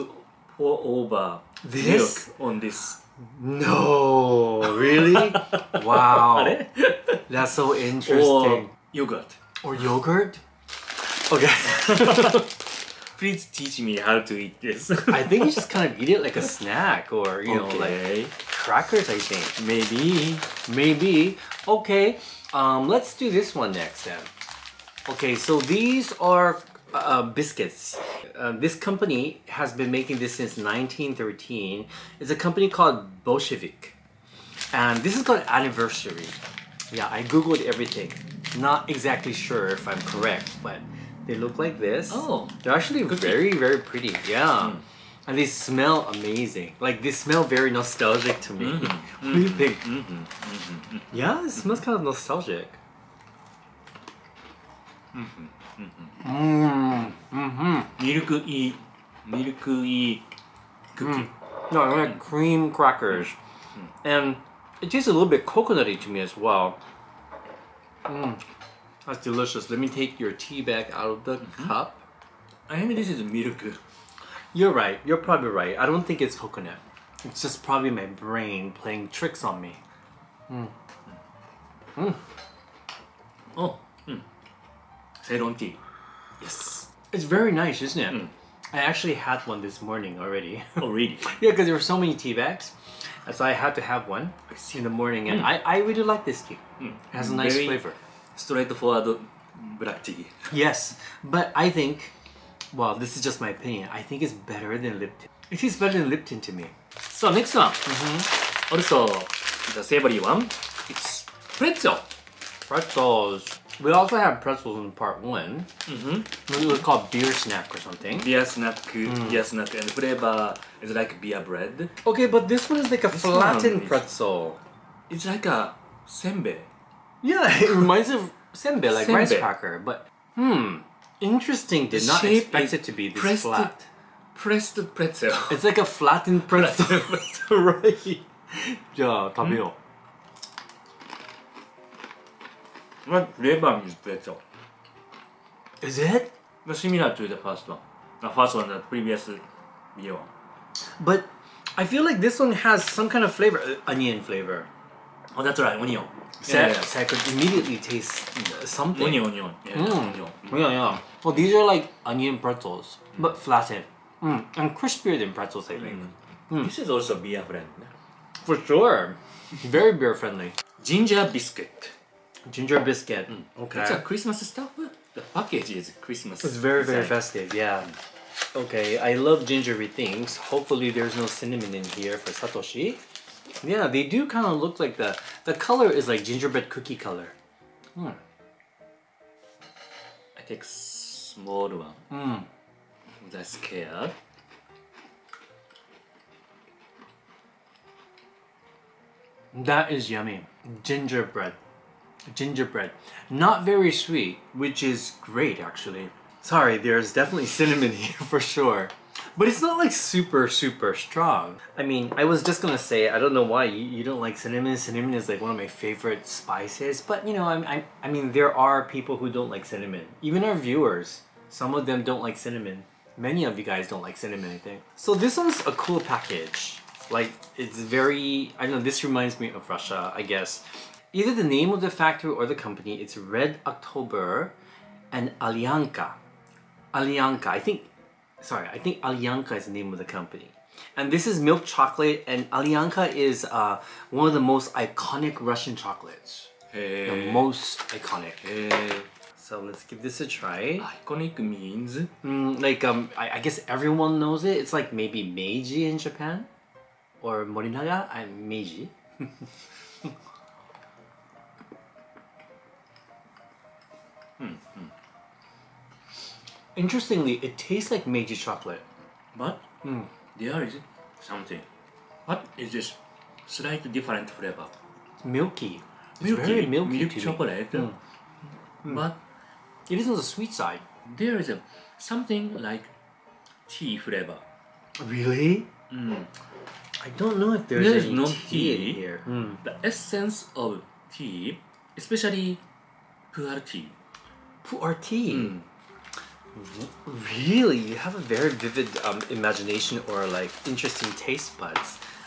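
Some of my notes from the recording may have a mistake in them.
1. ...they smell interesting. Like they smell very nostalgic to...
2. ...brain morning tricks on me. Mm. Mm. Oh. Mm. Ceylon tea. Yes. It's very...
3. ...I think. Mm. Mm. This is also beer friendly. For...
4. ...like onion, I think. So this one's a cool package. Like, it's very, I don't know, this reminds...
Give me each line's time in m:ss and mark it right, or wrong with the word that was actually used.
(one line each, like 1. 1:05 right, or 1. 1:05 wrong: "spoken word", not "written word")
1. 0:45 wrong: "amazing", not "interesting"
2. 1:18 wrong: "playing", not "morning"
3. 2:45 right
4. 3:44 wrong: "cinnamon", not "onion".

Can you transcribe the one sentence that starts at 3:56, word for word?
Alyonka, I think, sorry, I think Alyonka is the name of the company.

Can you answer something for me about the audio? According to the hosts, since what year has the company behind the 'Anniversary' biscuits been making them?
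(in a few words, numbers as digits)
1913.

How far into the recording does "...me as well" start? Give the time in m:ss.
1:06.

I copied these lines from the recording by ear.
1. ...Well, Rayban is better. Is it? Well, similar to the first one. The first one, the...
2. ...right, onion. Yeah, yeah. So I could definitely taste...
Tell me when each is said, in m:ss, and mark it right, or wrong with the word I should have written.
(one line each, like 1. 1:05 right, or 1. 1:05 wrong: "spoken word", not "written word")
1. 2:23 right
2. 2:35 wrong: "immediately", not "definitely".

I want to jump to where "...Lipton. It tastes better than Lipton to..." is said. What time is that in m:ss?
1:45.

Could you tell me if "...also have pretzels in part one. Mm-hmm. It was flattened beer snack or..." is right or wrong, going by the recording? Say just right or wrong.
wrong.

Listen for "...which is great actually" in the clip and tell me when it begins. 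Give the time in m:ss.
3:24.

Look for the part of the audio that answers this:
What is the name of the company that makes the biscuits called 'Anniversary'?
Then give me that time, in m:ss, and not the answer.
0:33.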